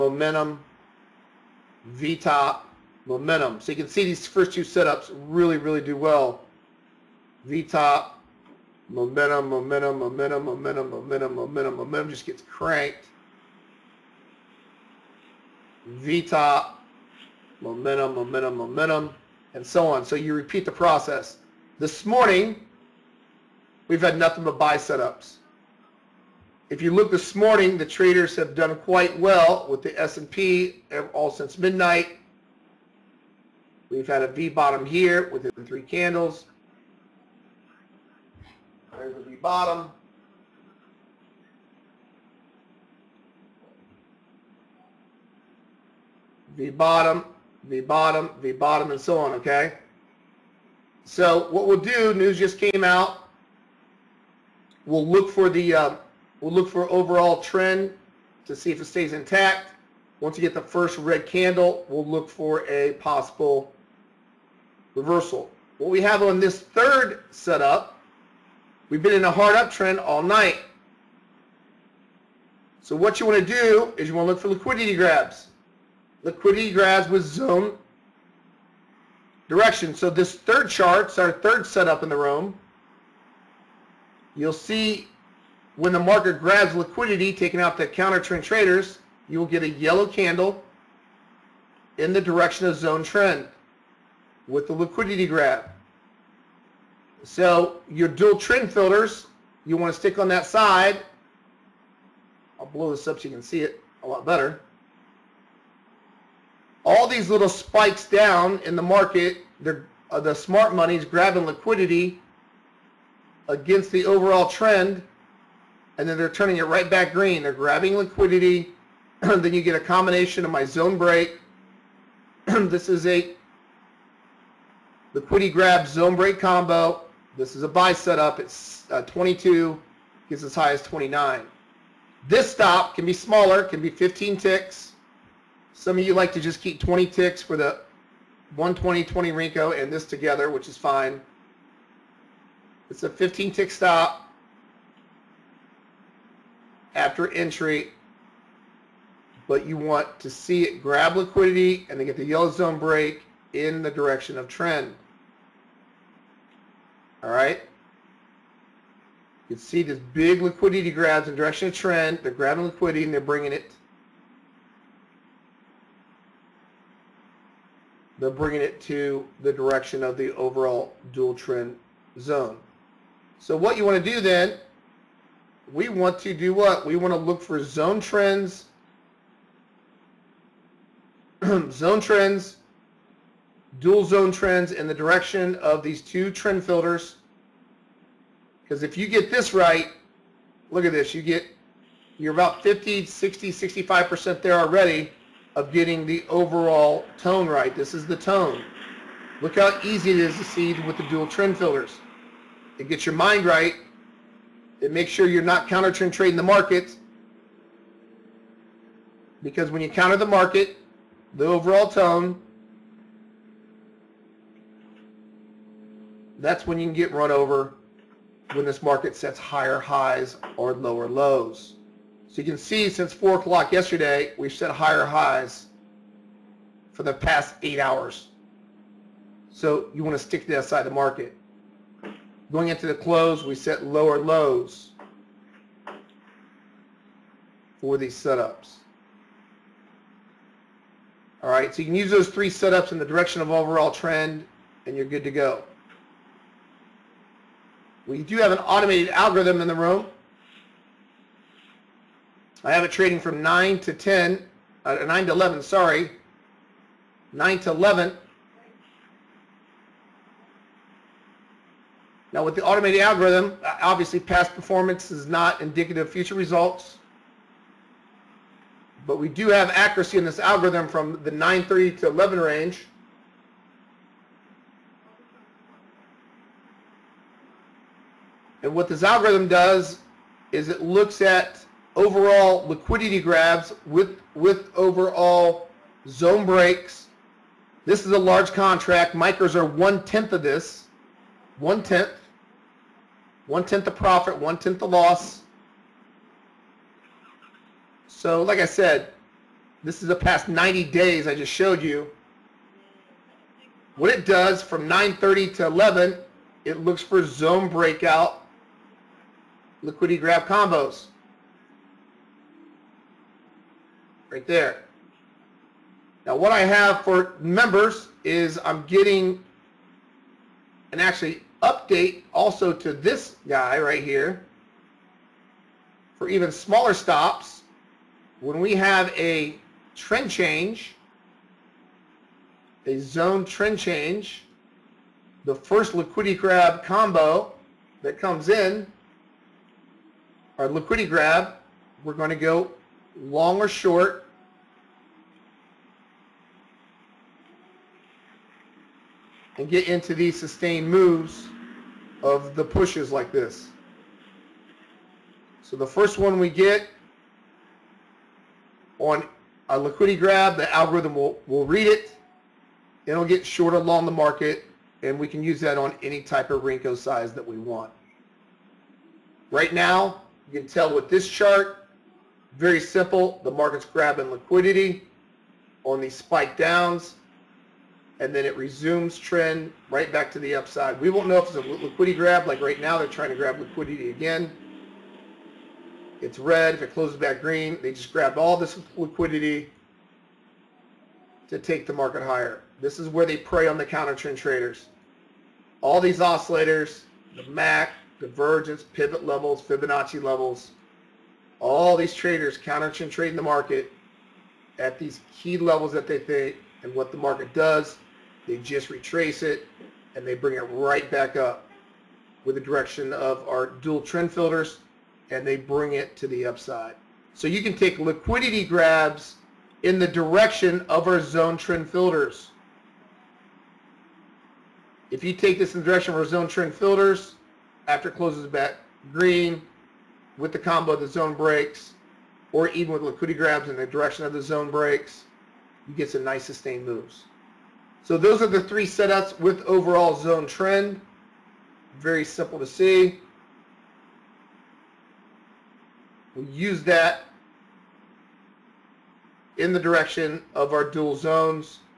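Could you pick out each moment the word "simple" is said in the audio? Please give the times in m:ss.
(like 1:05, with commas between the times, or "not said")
6:12, 7:22.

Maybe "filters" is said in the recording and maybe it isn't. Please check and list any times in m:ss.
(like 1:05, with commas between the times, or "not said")
1:38, 3:06, 3:21, 6:54, 7:01, 7:06.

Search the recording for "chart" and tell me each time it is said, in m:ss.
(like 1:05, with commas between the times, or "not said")
1:20, 6:11.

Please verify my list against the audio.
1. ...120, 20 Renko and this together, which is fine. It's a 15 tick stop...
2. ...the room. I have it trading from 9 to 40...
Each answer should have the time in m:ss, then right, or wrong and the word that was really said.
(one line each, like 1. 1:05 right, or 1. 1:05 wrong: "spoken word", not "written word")
1. 2:18 right
2. 4:09 wrong: "10", not "40".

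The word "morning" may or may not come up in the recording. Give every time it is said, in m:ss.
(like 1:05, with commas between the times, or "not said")
0:22, 0:27.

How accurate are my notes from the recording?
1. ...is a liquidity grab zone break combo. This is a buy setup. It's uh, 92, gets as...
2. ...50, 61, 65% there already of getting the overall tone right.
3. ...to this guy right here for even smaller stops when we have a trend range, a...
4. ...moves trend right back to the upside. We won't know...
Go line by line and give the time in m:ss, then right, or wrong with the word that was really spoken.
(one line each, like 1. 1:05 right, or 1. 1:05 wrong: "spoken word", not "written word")
1. 2:02 wrong: "22", not "92"
2. 3:12 wrong: "60", not "61"
3. 5:22 wrong: "change", not "range"
4. 6:18 wrong: "resumes", not "moves".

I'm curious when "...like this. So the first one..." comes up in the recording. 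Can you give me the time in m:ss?
5:53.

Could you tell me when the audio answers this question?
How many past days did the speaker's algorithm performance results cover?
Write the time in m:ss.
5:00.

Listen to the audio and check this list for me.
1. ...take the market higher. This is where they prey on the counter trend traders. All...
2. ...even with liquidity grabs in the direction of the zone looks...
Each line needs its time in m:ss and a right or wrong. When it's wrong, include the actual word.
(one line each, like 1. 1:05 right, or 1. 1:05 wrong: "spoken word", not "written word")
1. 6:31 right
2. 7:12 wrong: "breaks", not "looks".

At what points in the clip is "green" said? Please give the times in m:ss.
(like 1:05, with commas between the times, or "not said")
1:57, 6:27, 7:09.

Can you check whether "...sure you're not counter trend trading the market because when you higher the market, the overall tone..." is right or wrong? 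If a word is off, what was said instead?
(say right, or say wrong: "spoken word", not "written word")
wrong: "counter", not "higher".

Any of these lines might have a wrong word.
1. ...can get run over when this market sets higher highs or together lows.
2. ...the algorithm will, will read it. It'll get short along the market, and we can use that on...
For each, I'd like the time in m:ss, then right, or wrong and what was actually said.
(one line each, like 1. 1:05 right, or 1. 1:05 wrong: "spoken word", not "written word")
1. 3:36 wrong: "lower", not "together"
2. 6:00 right.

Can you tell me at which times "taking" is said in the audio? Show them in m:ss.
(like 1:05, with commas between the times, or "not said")
1:27.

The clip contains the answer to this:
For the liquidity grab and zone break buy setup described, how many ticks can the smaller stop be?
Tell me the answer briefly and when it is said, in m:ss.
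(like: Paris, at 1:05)
15 ticks, at 2:13.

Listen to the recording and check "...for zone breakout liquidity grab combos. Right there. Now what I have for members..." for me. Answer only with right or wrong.
right.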